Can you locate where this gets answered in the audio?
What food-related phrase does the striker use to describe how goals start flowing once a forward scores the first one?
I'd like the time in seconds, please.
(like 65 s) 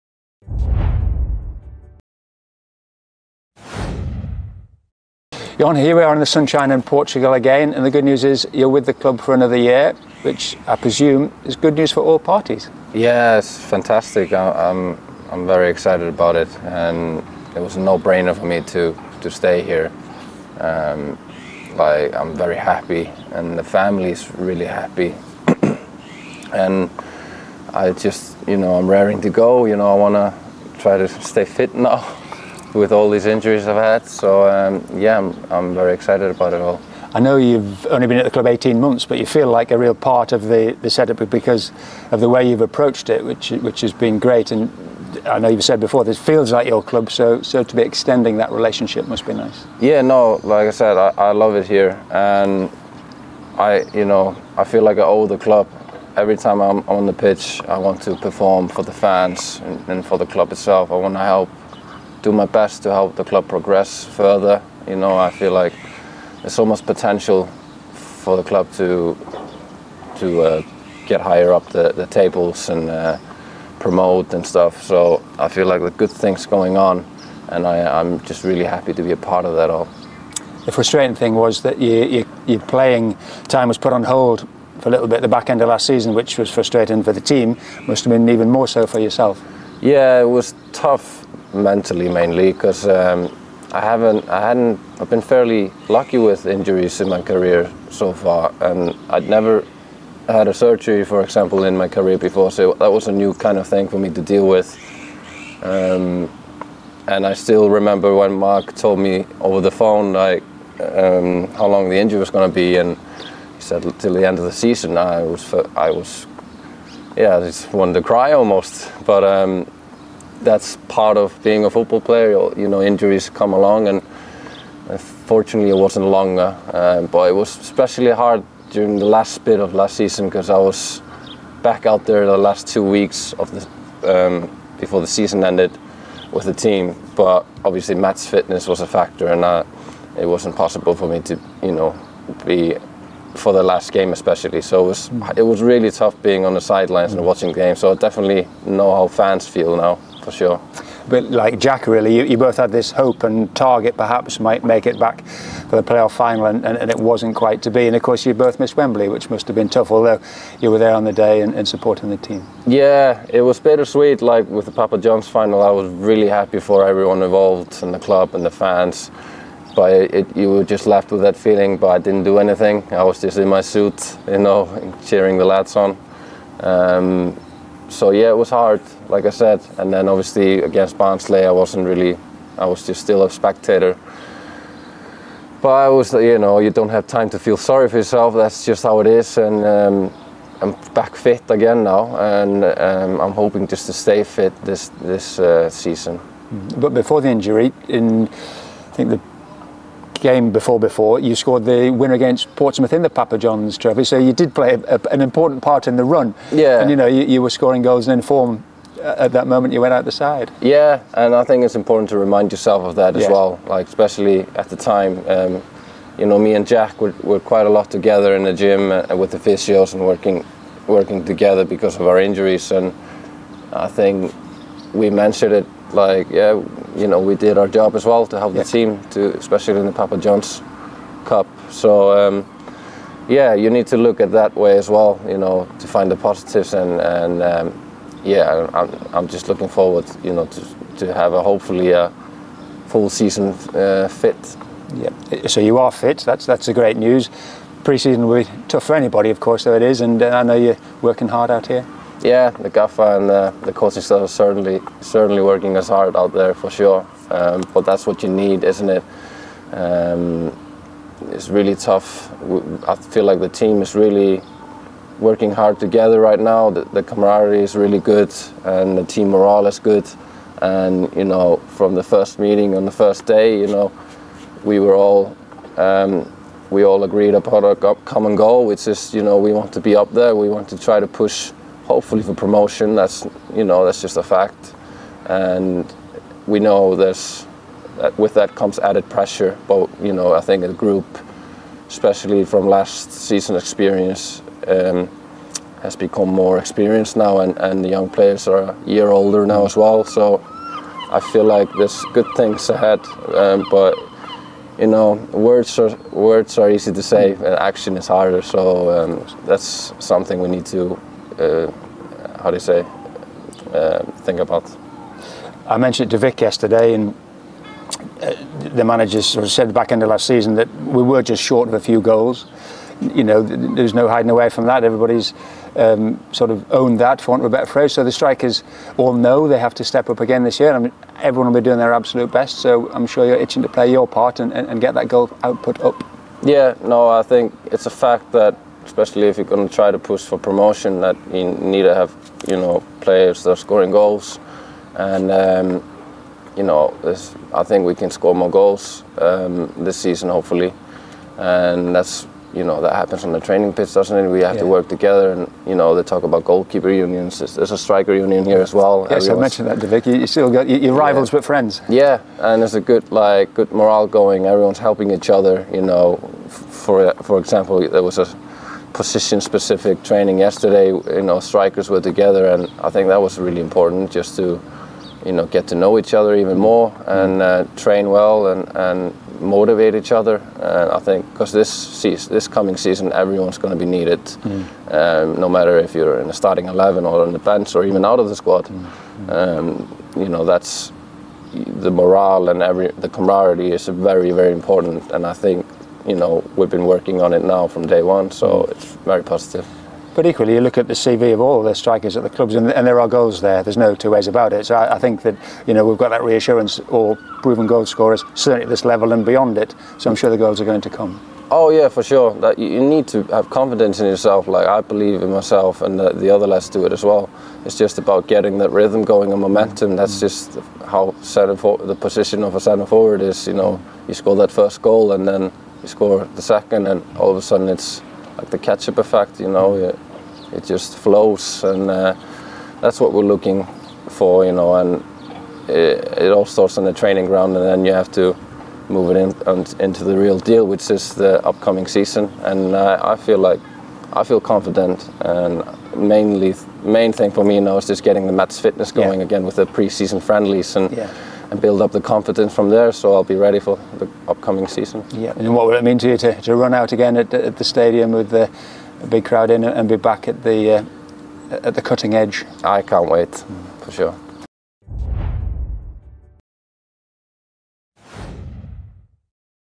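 428 s.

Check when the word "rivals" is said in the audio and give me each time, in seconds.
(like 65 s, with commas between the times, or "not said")
360 s.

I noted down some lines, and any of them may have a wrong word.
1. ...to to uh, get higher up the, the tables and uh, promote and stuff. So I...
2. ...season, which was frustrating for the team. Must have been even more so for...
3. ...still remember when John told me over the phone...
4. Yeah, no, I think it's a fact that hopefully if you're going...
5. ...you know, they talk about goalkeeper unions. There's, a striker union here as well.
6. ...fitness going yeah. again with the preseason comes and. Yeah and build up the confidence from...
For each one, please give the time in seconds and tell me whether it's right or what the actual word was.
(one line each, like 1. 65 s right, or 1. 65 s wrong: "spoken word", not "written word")
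1. 68 s right
2. 85 s right
3. 107 s wrong: "Mark", not "John"
4. 336 s wrong: "especially", not "hopefully"
5. 355 s right
6. 448 s wrong: "friendlies", not "comes".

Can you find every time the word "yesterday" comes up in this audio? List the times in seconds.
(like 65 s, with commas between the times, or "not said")
316 s, 370 s.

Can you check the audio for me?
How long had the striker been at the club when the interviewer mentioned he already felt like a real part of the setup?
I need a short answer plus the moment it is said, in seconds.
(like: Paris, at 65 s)
18 months, at 38 s.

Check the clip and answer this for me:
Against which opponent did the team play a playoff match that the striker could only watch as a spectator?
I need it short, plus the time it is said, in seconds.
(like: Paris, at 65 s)
Barnsley, at 180 s.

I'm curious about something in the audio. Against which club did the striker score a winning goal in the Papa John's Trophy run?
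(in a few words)
Portsmouth.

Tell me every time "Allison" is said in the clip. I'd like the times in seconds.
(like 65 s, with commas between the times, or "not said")
not said.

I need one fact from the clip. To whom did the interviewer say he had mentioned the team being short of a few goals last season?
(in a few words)
Vic.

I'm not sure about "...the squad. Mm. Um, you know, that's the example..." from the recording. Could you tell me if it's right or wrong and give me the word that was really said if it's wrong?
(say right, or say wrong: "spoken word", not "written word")
wrong: "morale", not "example".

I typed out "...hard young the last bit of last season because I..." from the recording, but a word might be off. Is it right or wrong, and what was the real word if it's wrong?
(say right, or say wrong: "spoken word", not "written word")
wrong: "during", not "young".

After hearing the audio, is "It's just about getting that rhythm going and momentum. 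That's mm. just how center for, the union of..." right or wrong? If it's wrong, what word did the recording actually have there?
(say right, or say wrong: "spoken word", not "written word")
wrong: "position", not "union".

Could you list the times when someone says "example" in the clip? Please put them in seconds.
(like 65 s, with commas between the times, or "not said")
101 s, 367 s.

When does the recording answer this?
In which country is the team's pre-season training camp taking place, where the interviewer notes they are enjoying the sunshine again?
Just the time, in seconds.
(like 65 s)
6 s.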